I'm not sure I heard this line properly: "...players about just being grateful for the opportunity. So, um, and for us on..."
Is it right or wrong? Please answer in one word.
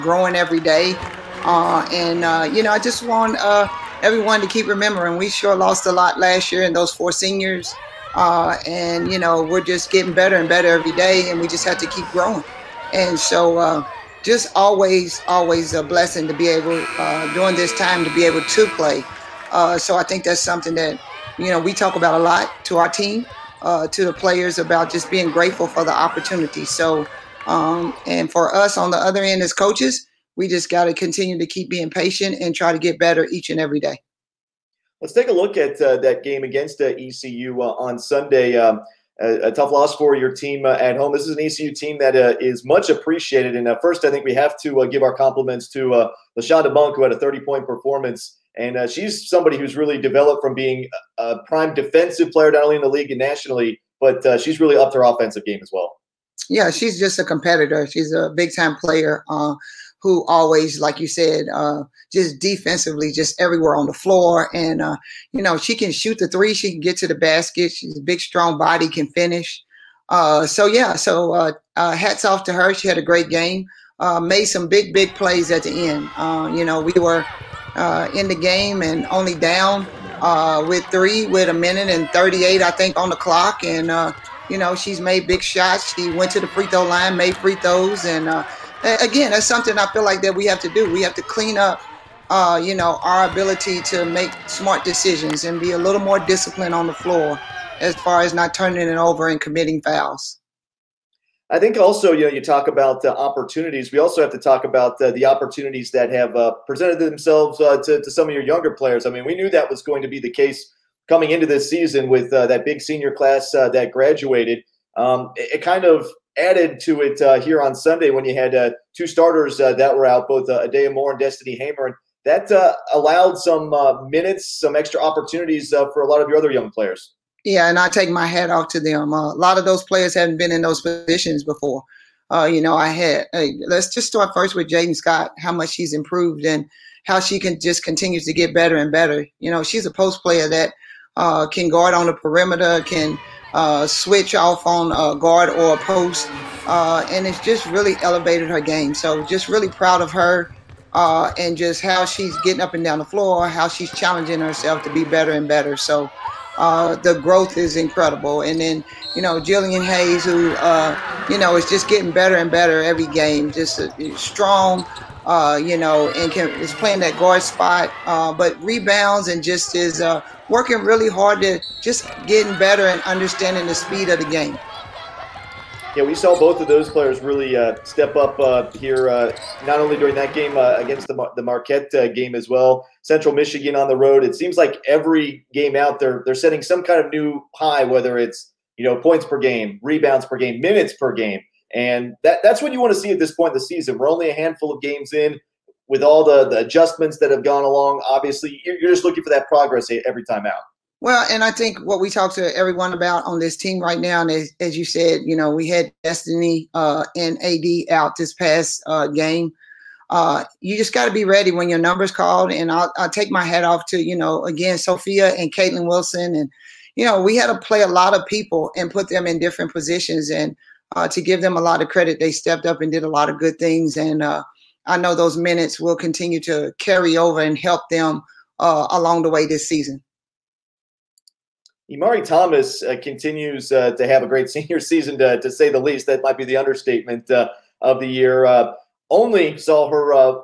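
right.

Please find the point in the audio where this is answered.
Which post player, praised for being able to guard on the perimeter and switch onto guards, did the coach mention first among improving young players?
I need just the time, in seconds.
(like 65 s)
134 s.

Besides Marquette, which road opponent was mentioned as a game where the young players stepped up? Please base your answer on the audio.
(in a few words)
Central Michigan.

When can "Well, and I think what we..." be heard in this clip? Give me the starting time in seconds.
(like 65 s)
201 s.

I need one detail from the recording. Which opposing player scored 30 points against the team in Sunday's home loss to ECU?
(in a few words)
LaShonda Monk.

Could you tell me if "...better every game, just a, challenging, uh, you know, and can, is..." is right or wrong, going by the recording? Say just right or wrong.
wrong.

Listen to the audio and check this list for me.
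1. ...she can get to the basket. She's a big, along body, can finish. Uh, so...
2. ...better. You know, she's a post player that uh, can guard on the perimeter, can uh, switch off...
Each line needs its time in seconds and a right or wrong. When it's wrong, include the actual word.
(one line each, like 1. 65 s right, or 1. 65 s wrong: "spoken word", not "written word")
1. 66 s wrong: "strong", not "along"
2. 138 s right.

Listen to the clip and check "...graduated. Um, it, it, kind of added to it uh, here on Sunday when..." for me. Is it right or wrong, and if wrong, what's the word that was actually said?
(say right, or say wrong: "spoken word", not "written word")
right.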